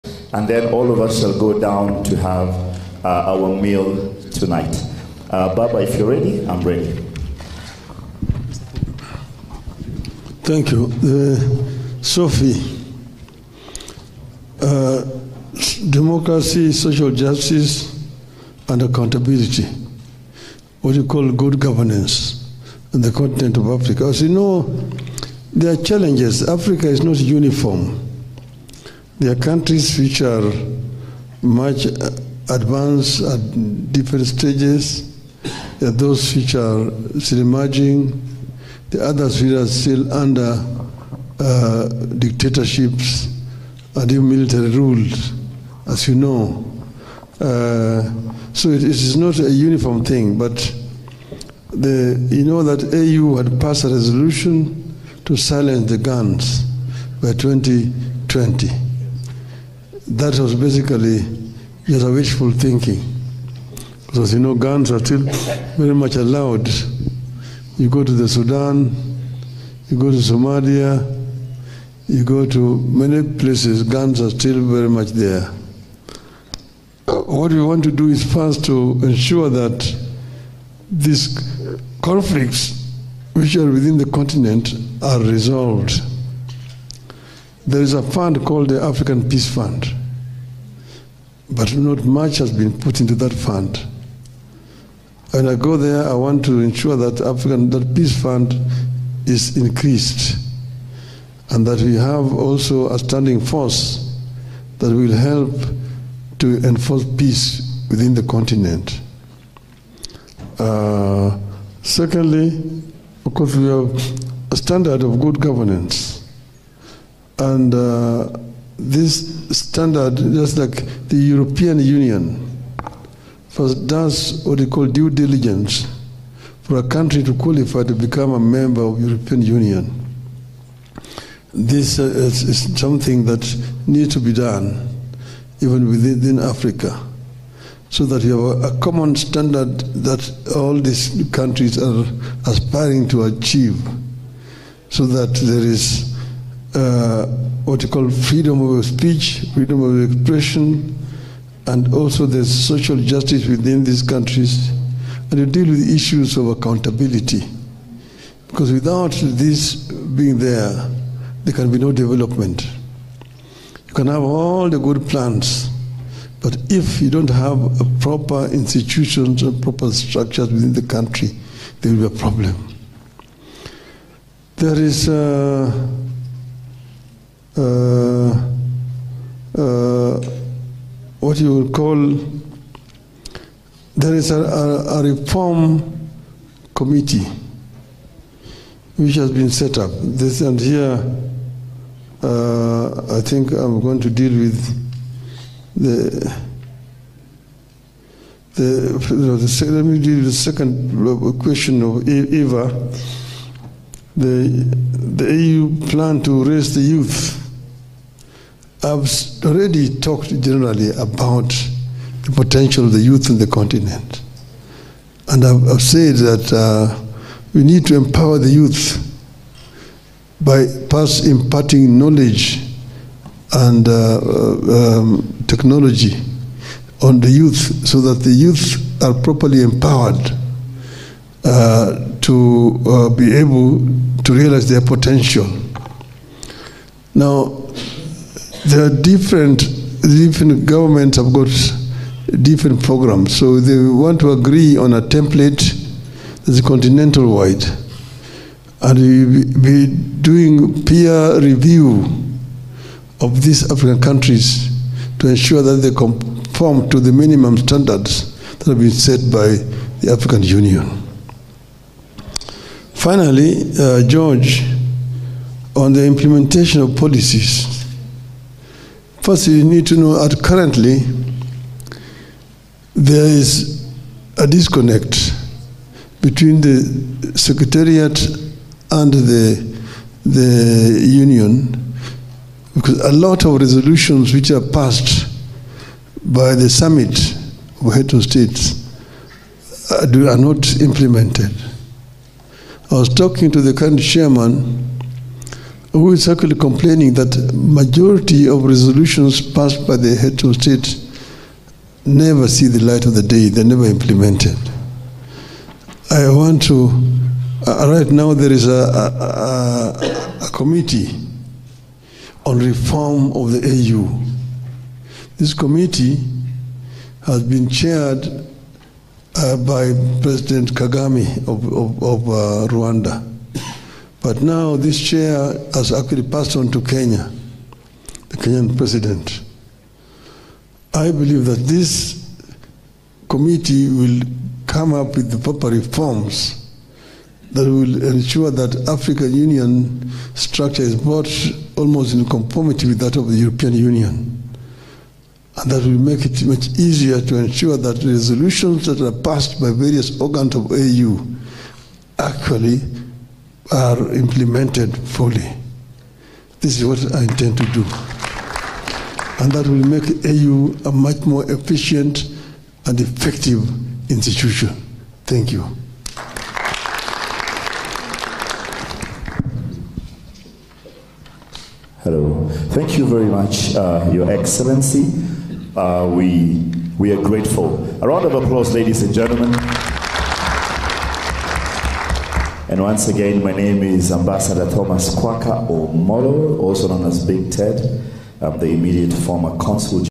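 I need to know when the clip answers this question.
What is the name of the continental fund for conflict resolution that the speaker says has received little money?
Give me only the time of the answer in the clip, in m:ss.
1:28.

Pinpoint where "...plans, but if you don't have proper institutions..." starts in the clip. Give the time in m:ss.
2:45.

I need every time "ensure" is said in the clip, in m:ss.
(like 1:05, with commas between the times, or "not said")
1:19, 1:36, 4:15, 5:38, 5:47.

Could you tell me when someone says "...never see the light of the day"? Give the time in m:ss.
5:02.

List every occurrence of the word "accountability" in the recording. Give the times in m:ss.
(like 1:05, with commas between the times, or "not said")
0:18, 2:36.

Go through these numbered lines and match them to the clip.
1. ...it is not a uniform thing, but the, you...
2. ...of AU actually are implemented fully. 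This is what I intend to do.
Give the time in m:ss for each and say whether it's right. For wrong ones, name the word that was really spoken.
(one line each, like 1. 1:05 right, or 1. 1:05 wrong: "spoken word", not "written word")
1. 0:48 right
2. 5:50 right.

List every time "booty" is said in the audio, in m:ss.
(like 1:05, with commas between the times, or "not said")
not said.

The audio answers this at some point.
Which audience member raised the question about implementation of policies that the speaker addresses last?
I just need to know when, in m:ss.
4:24.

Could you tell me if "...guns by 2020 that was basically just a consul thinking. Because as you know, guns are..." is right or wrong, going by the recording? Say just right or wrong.
wrong.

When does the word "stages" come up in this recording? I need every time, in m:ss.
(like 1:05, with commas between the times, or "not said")
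0:34.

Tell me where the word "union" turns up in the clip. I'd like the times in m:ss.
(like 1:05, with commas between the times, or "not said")
2:01, 2:09, 4:20, 4:41, 5:39, 5:43.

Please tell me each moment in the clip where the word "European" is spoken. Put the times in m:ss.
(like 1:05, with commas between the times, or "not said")
2:01, 2:08, 5:43.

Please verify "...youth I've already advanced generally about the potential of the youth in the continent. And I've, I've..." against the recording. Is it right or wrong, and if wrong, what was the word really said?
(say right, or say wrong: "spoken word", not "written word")
wrong: "talked", not "advanced".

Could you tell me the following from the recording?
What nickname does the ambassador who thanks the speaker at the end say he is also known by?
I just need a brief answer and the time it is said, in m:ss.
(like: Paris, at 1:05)
Big Ted, at 6:27.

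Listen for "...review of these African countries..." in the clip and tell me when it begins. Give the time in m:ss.
4:11.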